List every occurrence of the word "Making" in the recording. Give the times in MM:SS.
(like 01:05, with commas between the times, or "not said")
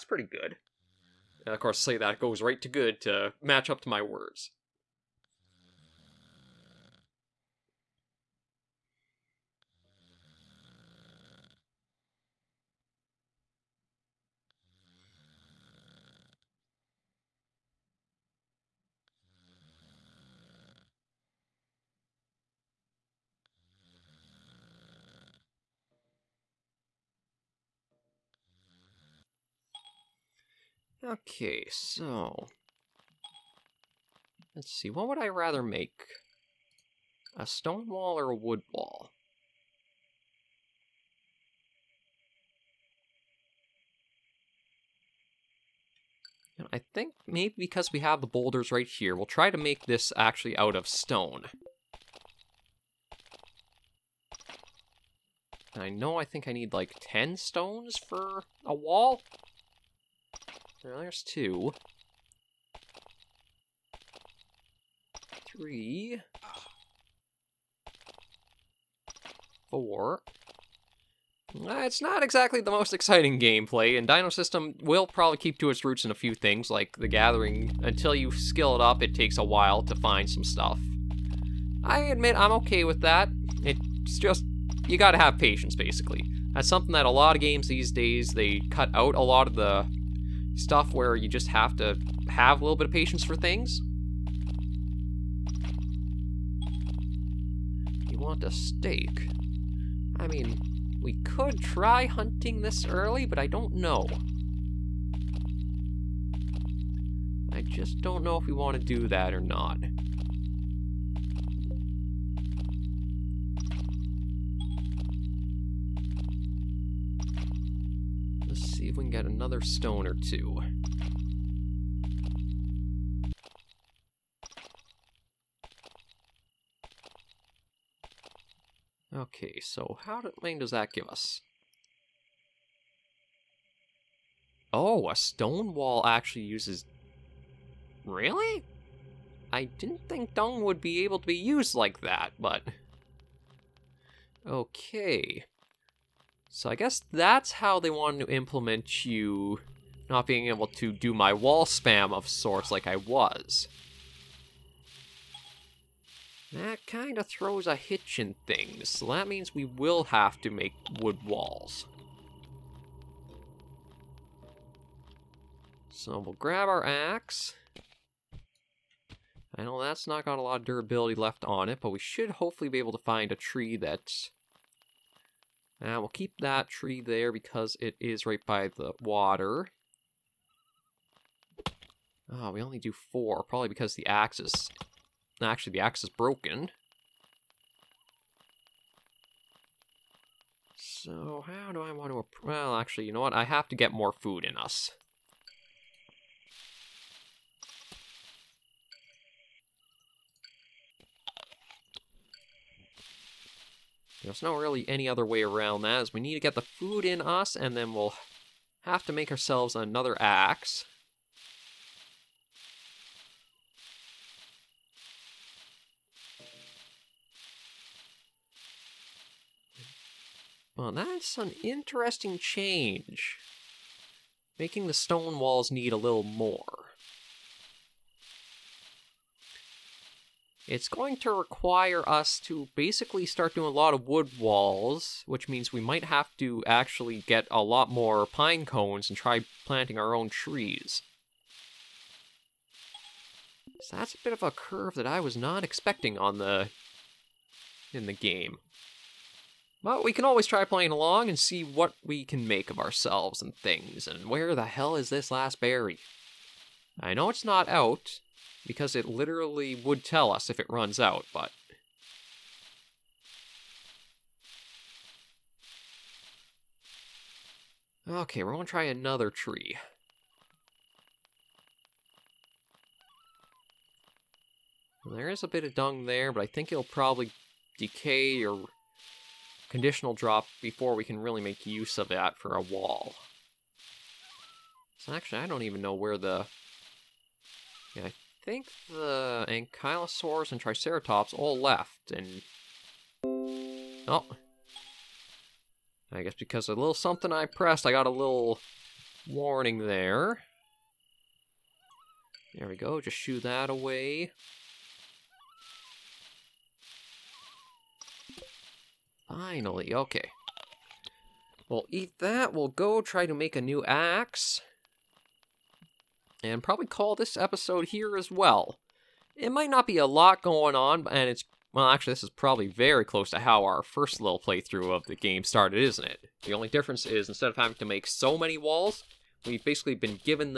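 03:44.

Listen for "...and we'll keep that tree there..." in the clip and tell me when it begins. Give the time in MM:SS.
02:55.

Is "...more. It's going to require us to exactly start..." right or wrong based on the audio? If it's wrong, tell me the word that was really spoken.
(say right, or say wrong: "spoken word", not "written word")
wrong: "basically", not "exactly".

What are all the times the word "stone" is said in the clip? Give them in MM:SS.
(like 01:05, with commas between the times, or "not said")
00:37, 00:50, 00:57, 01:59, 02:15, 03:44.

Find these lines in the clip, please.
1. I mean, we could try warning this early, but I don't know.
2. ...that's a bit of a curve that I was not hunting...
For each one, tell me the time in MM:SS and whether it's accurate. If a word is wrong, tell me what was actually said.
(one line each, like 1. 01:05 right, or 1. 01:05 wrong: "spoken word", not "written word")
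1. 01:40 wrong: "hunting", not "warning"
2. 04:03 wrong: "expecting", not "hunting".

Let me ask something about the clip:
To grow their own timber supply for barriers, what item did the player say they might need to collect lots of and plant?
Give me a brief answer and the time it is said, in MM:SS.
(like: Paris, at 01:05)
pine cones, at 03:58.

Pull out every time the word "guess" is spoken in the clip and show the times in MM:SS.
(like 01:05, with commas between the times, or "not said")
02:26, 04:56.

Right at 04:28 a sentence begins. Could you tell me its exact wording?
Okay, we're gonna try another tree.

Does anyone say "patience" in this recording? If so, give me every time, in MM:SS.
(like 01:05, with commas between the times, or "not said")
01:25, 01:32.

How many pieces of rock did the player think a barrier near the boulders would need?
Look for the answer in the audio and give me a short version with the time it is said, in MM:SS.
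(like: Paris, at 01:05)
10, at 00:56.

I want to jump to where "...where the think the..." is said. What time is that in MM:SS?
04:45.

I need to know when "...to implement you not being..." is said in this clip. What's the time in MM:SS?
02:28.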